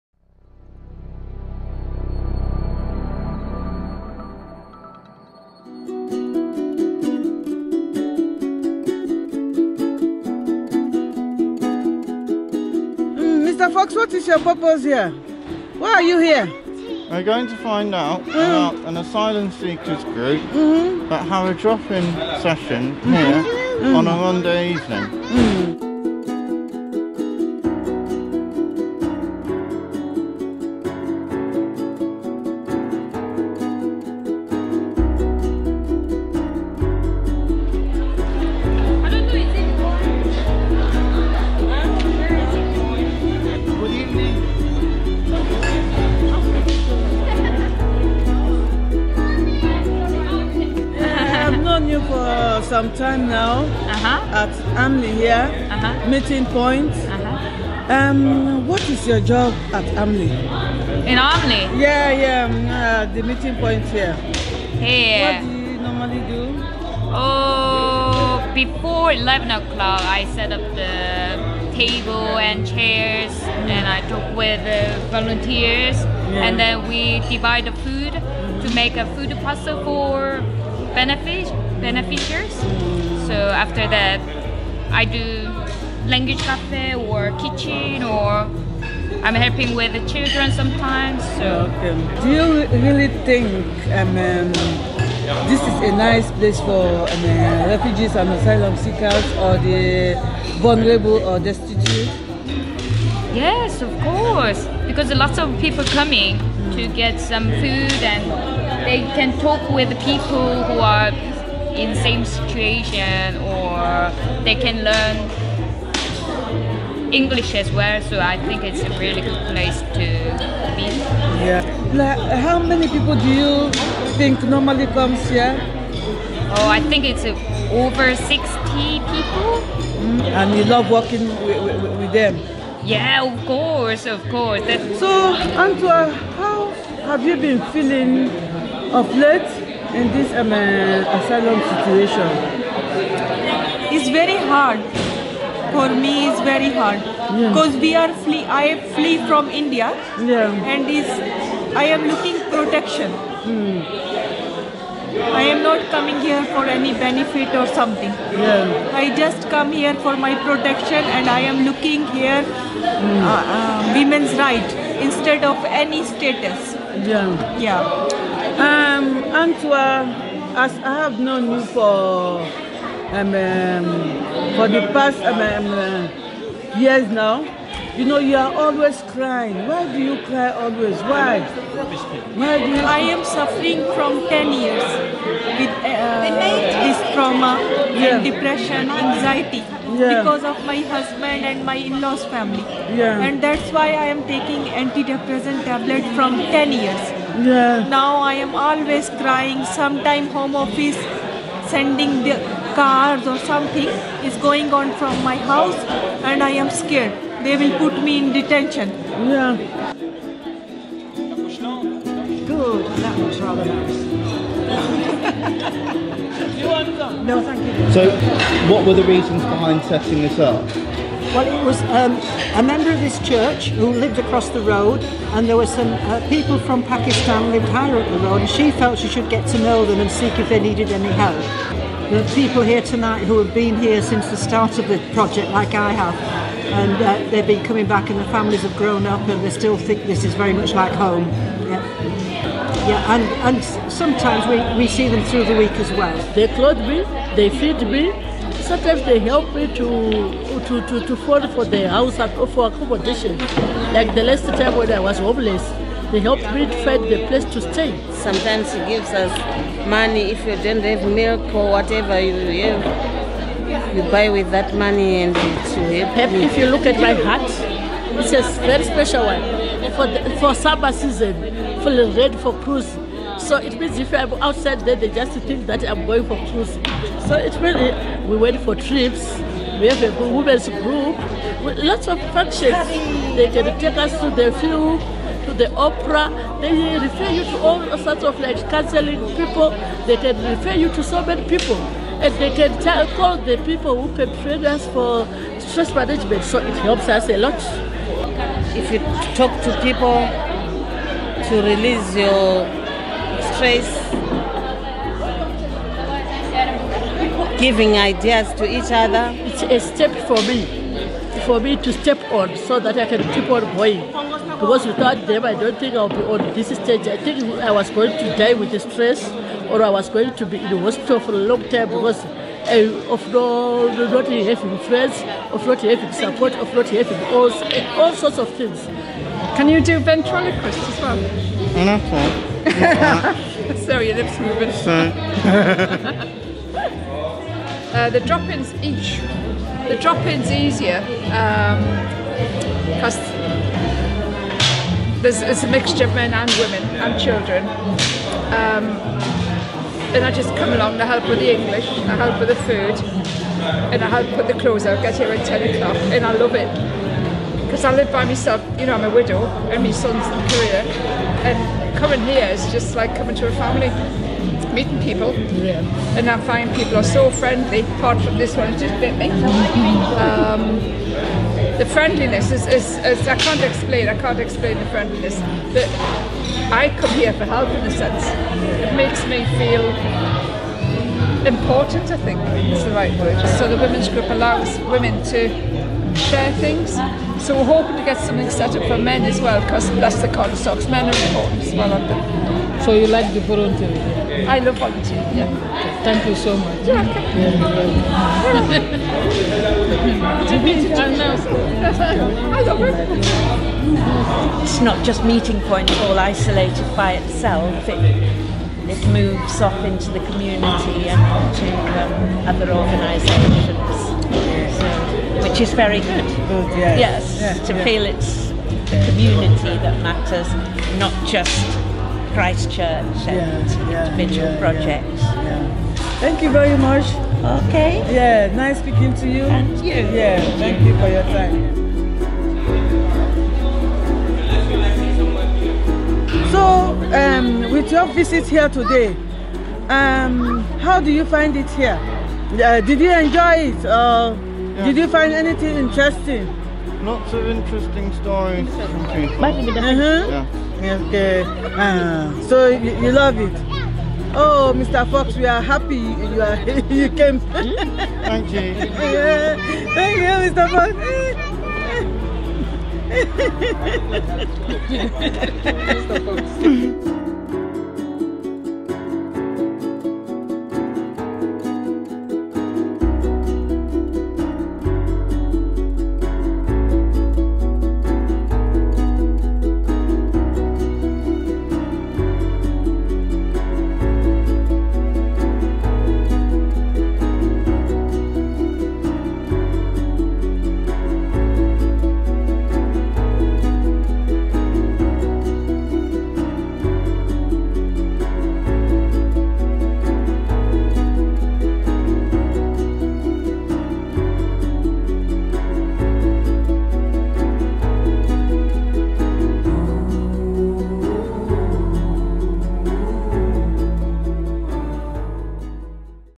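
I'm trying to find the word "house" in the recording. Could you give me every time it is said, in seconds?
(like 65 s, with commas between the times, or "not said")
205 s, 251 s.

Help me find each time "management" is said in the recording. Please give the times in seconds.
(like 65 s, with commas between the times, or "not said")
295 s.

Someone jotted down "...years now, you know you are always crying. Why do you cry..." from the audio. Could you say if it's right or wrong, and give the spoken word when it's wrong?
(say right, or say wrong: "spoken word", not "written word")
right.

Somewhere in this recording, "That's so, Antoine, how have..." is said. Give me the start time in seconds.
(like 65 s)
134 s.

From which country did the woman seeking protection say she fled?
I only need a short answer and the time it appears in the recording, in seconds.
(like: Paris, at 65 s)
India, at 149 s.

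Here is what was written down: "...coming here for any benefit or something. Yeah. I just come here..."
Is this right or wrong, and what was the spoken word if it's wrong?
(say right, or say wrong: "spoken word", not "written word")
right.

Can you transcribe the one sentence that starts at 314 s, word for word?
Because without them, I don't think I'll be on this stage.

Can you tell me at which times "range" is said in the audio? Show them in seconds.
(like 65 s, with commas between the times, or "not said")
not said.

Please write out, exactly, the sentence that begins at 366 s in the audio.
and I find people are so friendly.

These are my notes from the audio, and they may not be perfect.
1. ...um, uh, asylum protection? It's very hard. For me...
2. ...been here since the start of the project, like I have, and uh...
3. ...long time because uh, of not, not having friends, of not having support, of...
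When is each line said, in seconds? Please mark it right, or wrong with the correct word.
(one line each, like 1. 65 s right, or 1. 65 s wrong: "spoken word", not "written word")
1. 140 s wrong: "situation", not "protection"
2. 233 s right
3. 321 s right.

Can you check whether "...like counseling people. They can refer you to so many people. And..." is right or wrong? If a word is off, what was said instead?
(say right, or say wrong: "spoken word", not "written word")
right.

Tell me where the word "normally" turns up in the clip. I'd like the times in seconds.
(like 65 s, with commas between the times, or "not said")
65 s, 124 s.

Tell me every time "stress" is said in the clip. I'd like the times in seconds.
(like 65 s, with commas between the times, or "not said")
295 s, 303 s, 318 s.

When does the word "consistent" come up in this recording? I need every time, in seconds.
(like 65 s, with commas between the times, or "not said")
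not said.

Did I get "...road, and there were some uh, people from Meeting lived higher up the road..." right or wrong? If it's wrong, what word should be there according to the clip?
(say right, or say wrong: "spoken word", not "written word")
wrong: "Pakistan", not "Meeting".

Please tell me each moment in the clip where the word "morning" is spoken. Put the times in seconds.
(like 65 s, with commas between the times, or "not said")
not said.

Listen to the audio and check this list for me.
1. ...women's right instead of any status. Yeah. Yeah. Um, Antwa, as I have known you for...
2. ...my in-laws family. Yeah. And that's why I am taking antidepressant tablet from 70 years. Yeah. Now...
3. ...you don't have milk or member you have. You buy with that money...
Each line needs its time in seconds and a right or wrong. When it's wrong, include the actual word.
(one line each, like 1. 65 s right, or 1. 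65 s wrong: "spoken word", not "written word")
1. 163 s right
2. 191 s wrong: "10", not "70"
3. 260 s wrong: "whatever", not "member".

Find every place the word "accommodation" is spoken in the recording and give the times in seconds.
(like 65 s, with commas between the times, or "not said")
252 s.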